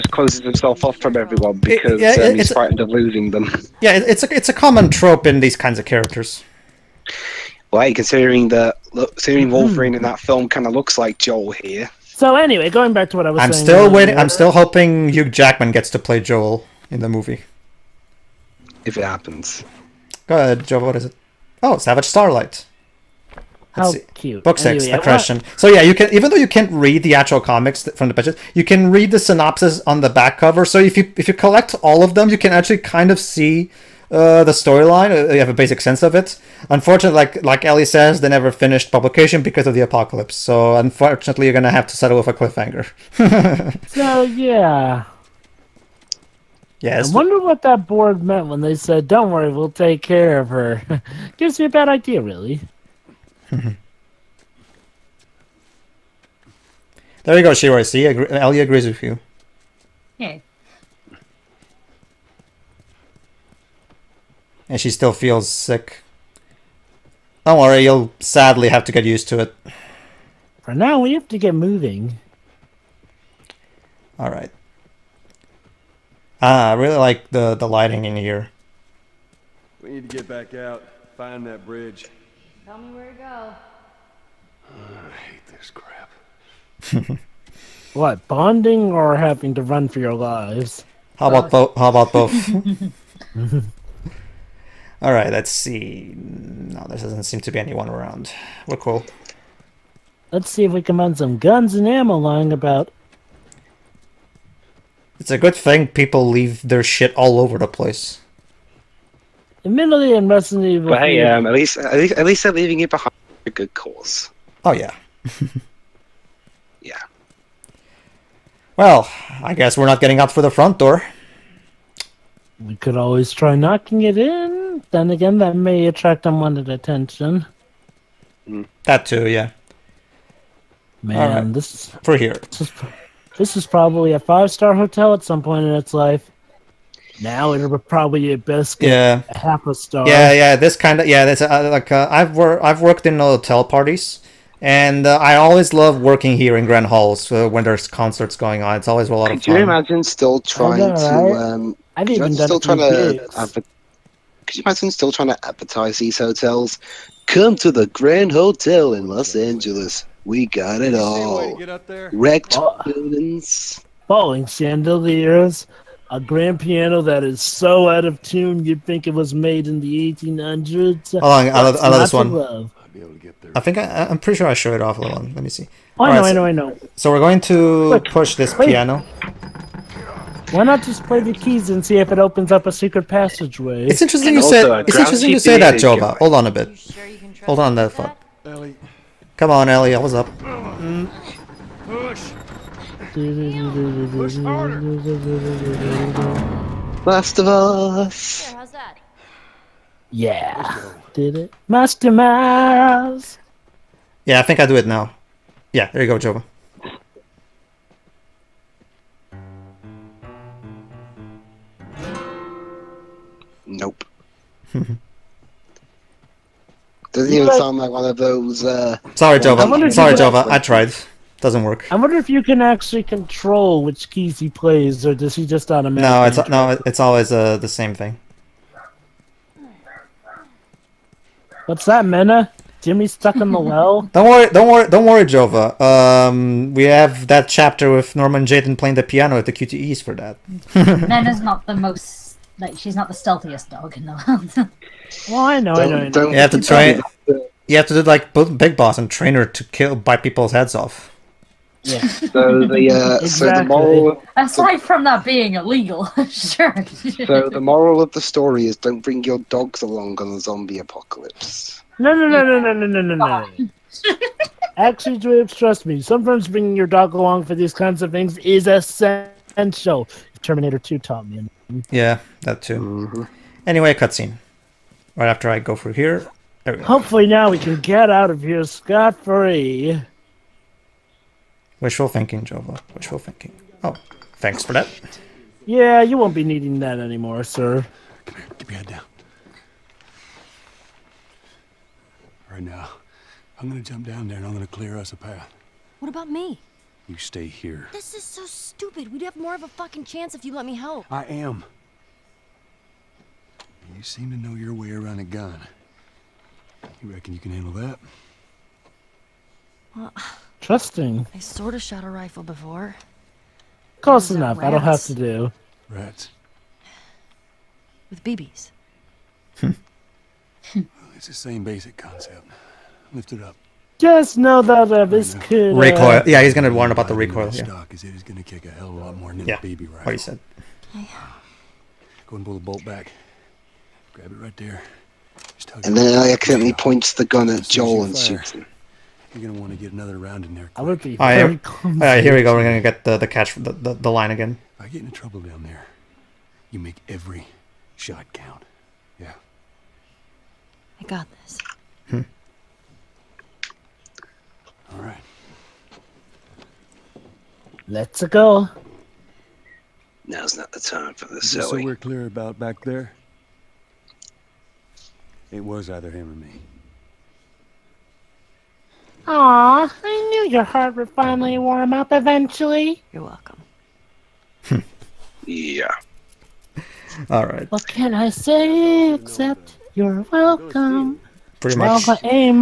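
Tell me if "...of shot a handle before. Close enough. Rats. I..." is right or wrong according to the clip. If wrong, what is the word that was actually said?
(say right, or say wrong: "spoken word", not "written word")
wrong: "rifle", not "handle".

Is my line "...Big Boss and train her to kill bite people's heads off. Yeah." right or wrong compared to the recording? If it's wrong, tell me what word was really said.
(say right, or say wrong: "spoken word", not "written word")
right.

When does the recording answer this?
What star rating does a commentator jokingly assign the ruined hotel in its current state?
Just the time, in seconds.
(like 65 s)
139 s.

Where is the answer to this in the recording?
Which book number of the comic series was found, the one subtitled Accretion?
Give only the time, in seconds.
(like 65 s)
24 s.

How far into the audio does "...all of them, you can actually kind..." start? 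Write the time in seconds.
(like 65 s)
31 s.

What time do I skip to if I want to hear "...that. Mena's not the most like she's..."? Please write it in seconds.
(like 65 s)
240 s.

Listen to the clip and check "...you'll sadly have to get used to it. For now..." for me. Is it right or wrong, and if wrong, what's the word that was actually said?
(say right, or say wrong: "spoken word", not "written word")
right.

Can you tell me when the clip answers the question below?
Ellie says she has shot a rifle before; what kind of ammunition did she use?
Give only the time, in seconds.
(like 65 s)
318 s.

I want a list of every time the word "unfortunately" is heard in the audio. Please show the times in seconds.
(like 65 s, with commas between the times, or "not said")
36 s, 40 s.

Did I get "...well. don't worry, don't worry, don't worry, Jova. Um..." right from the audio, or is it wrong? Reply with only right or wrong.
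right.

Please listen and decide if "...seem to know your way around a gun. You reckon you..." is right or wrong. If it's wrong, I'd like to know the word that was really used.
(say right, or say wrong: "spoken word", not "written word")
right.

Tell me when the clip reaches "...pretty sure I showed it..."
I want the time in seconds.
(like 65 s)
174 s.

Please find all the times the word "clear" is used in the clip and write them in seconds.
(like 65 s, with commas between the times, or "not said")
294 s, 361 s.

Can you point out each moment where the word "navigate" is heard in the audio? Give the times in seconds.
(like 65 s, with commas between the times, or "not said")
not said.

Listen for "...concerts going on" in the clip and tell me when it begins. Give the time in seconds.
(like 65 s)
147 s.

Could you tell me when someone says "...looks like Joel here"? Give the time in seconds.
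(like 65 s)
10 s.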